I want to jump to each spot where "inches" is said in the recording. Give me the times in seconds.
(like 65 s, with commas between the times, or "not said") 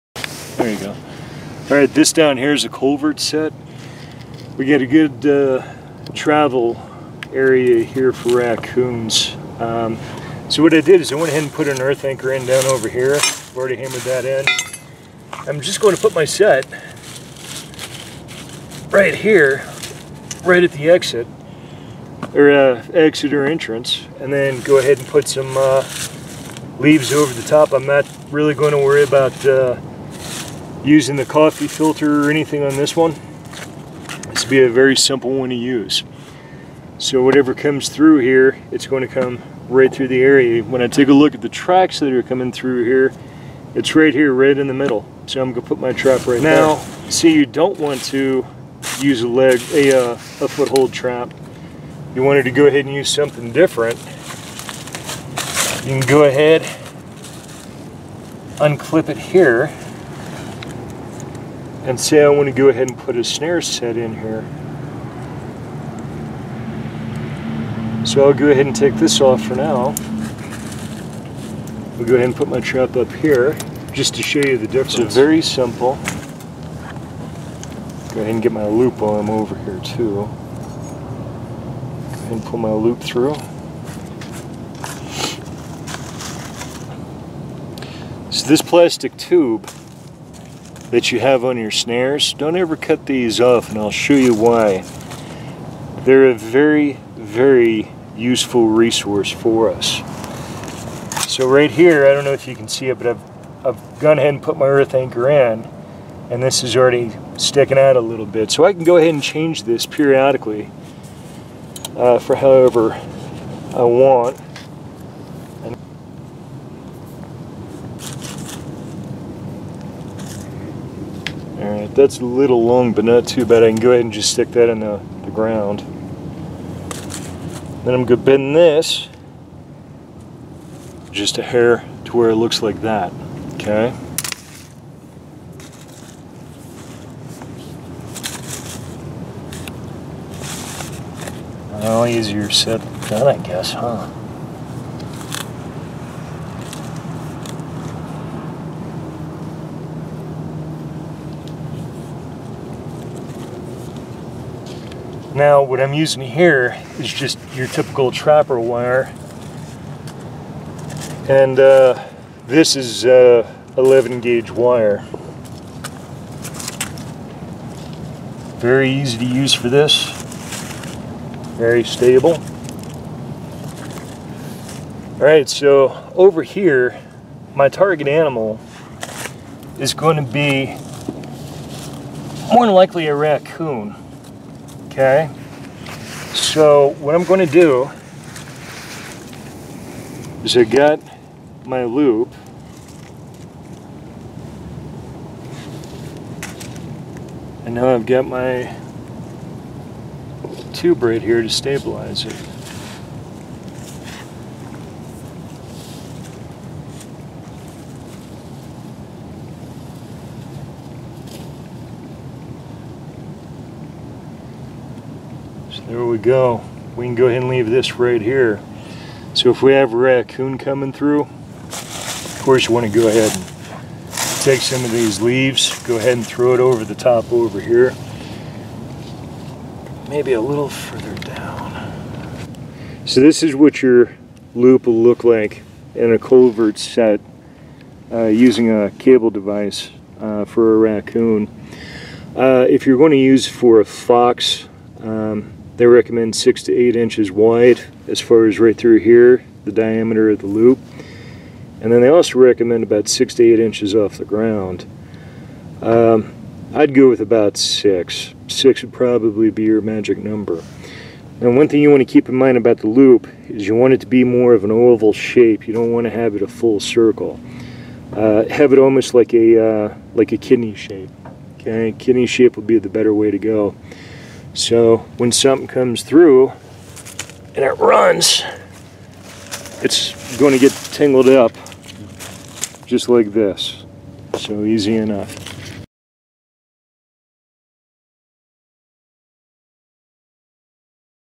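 246 s, 253 s.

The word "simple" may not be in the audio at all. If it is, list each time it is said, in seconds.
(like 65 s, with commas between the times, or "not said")
34 s, 75 s.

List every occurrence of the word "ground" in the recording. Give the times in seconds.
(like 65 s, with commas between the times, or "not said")
125 s, 254 s.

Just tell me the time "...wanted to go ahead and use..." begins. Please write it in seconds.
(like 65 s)
52 s.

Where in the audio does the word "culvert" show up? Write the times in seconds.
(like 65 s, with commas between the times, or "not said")
2 s, 236 s.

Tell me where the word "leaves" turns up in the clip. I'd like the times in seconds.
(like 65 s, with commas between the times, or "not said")
26 s, 217 s, 225 s.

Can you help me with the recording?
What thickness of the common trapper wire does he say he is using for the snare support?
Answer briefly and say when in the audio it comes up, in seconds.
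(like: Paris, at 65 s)
11 gauge, at 163 s.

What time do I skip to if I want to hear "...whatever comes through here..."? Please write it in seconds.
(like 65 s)
37 s.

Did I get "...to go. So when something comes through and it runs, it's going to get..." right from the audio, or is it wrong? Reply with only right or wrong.
right.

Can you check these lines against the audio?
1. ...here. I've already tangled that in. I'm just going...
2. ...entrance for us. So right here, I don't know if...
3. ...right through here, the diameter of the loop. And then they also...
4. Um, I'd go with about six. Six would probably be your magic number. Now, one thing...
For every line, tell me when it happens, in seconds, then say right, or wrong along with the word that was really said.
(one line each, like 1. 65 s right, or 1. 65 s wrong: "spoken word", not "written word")
1. 12 s wrong: "hammered", not "tangled"
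2. 98 s wrong: "resource", not "entrance"
3. 248 s right
4. 255 s right.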